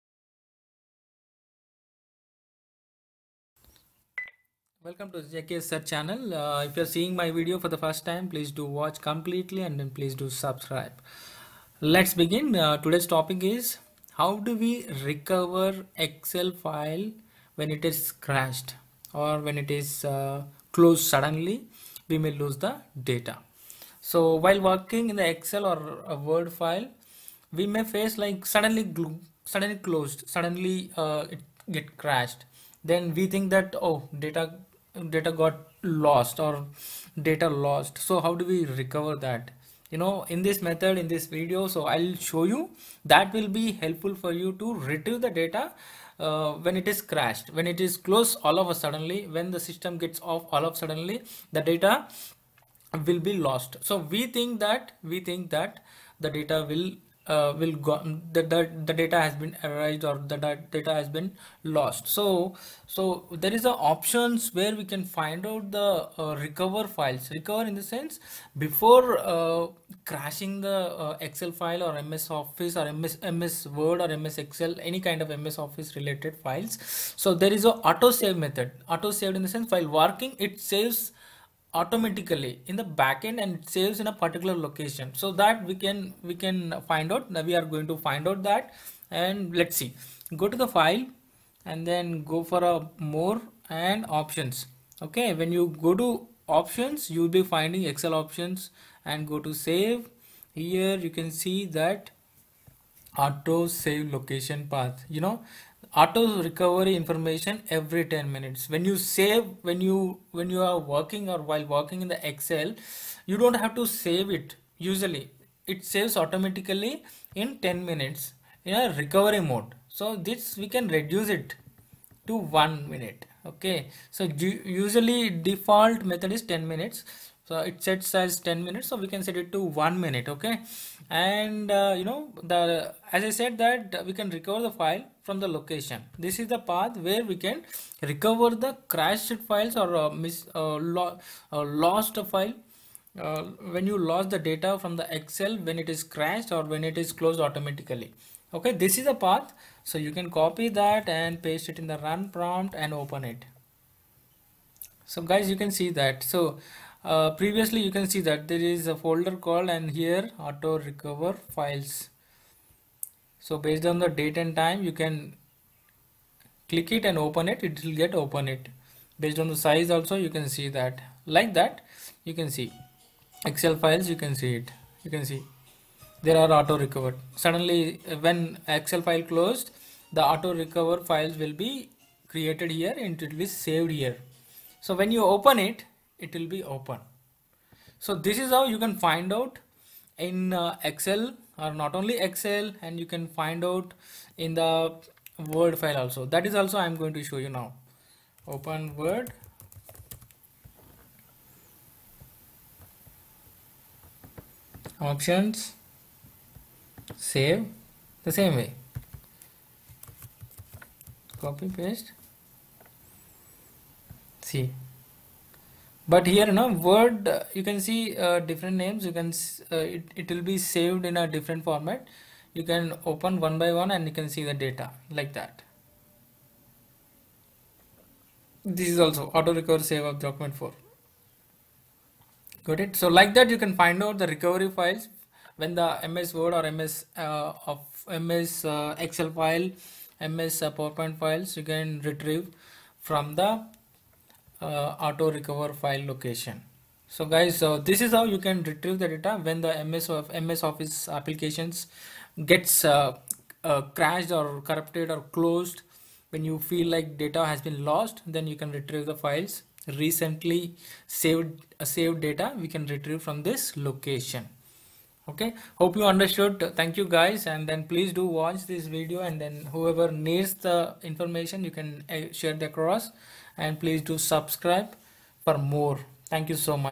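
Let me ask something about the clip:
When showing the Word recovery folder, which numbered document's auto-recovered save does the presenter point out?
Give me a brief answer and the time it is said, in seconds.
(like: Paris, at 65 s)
Document 4, at 230 s.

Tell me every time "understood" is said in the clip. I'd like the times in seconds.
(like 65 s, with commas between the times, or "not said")
266 s.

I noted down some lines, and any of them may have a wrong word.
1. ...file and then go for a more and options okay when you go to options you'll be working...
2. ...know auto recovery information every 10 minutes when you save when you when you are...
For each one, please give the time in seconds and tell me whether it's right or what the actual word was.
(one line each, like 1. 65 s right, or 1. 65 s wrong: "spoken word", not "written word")
1. 90 s wrong: "finding", not "working"
2. 105 s right.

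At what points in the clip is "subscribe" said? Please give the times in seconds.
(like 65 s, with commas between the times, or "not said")
10 s, 274 s.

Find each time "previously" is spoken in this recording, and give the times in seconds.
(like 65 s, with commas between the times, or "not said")
157 s.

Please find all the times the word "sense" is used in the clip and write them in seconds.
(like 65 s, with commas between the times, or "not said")
67 s, 79 s.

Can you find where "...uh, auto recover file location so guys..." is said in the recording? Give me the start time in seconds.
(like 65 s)
244 s.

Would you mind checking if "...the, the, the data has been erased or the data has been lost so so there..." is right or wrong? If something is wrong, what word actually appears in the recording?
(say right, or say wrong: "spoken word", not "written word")
right.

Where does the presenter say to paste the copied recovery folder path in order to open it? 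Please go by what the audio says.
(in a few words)
Run prompt.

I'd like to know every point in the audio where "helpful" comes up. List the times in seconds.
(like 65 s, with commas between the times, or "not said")
43 s.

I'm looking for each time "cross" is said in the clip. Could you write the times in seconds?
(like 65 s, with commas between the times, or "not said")
272 s.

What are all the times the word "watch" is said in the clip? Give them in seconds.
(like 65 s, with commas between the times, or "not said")
8 s, 268 s.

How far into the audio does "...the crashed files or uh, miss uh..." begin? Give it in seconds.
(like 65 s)
138 s.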